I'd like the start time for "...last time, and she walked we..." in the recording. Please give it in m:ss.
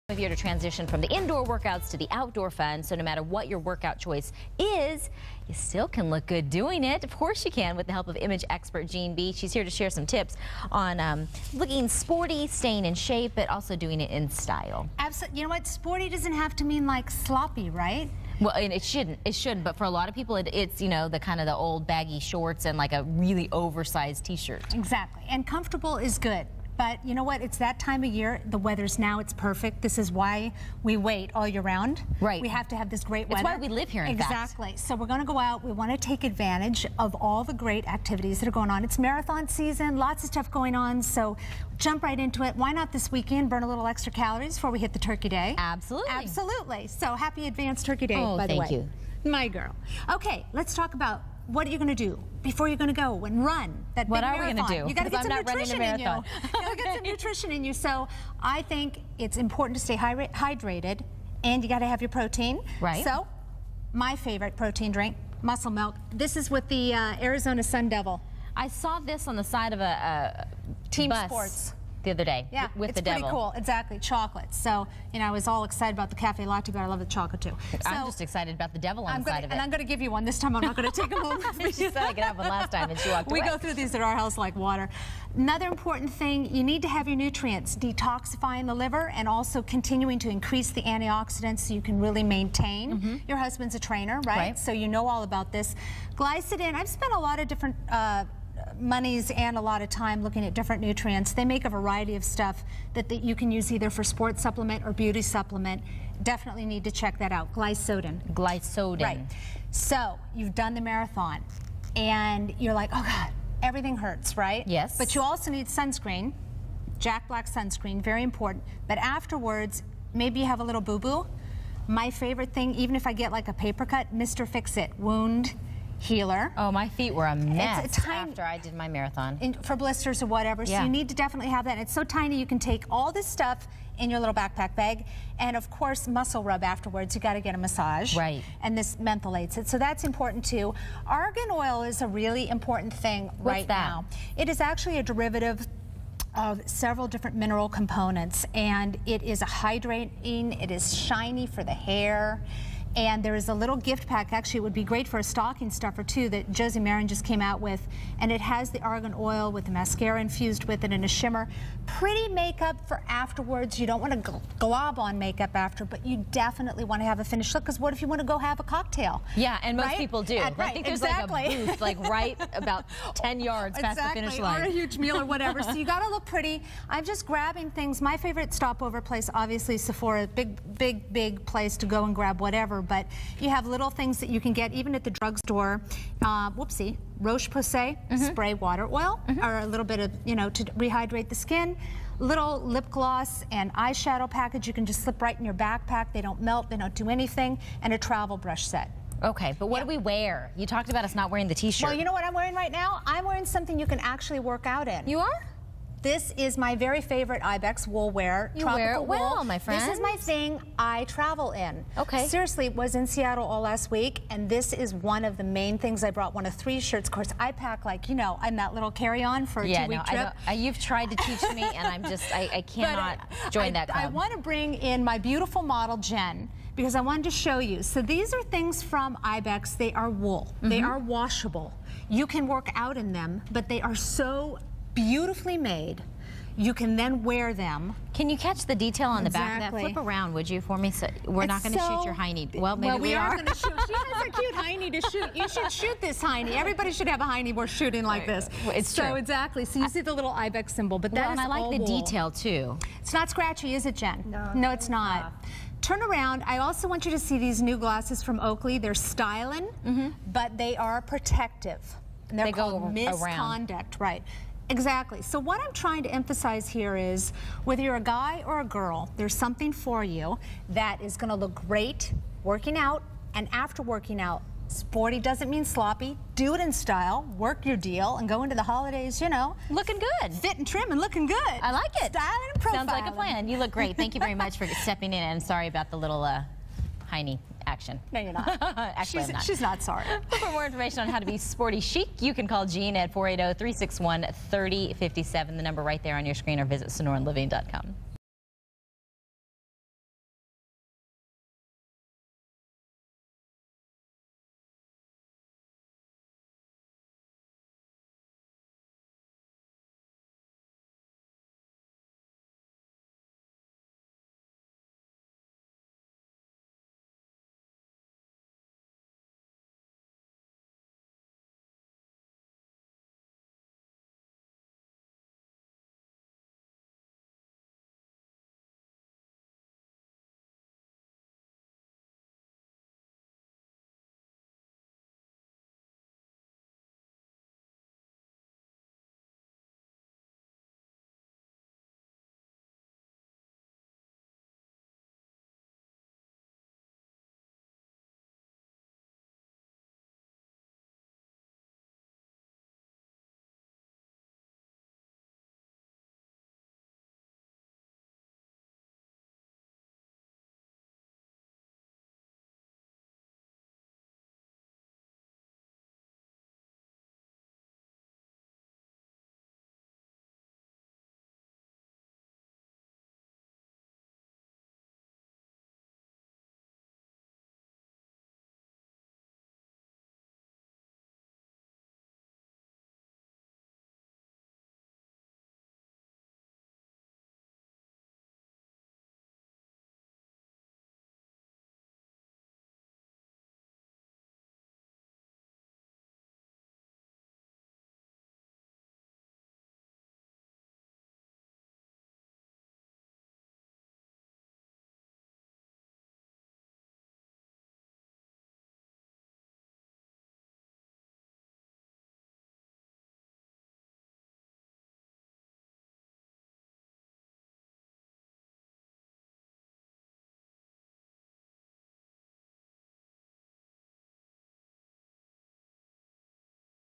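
1:22.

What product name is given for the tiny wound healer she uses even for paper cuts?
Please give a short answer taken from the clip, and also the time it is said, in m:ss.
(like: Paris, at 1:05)
Mr. Fix-It, at 2:04.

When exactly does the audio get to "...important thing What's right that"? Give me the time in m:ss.
2:22.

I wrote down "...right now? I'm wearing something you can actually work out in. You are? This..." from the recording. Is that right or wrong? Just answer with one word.
right.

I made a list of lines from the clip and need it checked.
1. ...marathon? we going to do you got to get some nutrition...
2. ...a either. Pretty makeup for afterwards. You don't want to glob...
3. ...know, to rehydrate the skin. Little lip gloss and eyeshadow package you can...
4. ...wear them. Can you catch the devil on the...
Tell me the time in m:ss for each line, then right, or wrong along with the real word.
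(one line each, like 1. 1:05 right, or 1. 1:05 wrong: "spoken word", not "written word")
1. 0:54 right
2. 2:41 wrong: "shimmer", not "either"
3. 3:10 right
4. 3:57 wrong: "detail", not "devil".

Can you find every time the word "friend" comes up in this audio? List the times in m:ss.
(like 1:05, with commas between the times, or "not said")
3:29.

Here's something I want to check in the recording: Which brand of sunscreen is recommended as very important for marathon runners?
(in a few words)
Jack Black.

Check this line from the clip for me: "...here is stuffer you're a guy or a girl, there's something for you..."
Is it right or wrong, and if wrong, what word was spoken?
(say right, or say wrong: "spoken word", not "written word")
wrong: "whether", not "stuffer".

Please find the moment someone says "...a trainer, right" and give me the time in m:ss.
1:33.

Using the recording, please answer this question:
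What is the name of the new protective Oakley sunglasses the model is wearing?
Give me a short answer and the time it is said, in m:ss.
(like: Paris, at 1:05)
Miss Conduct, at 4:22.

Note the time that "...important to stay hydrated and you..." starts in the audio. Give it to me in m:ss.
0:59.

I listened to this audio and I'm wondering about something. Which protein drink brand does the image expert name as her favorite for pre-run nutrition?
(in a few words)
Muscle Milk.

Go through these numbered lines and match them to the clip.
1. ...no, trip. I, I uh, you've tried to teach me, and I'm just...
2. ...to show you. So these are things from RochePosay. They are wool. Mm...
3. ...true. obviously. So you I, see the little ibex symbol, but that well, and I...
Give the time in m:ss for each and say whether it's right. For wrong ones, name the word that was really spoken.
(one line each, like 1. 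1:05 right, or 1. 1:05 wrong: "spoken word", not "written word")
1. 3:39 right
2. 3:47 wrong: "Ibex", not "RochePosay"
3. 4:09 wrong: "exactly", not "obviously".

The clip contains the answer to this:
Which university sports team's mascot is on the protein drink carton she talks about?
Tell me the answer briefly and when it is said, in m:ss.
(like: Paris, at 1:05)
Arizona Sun Devil, at 1:07.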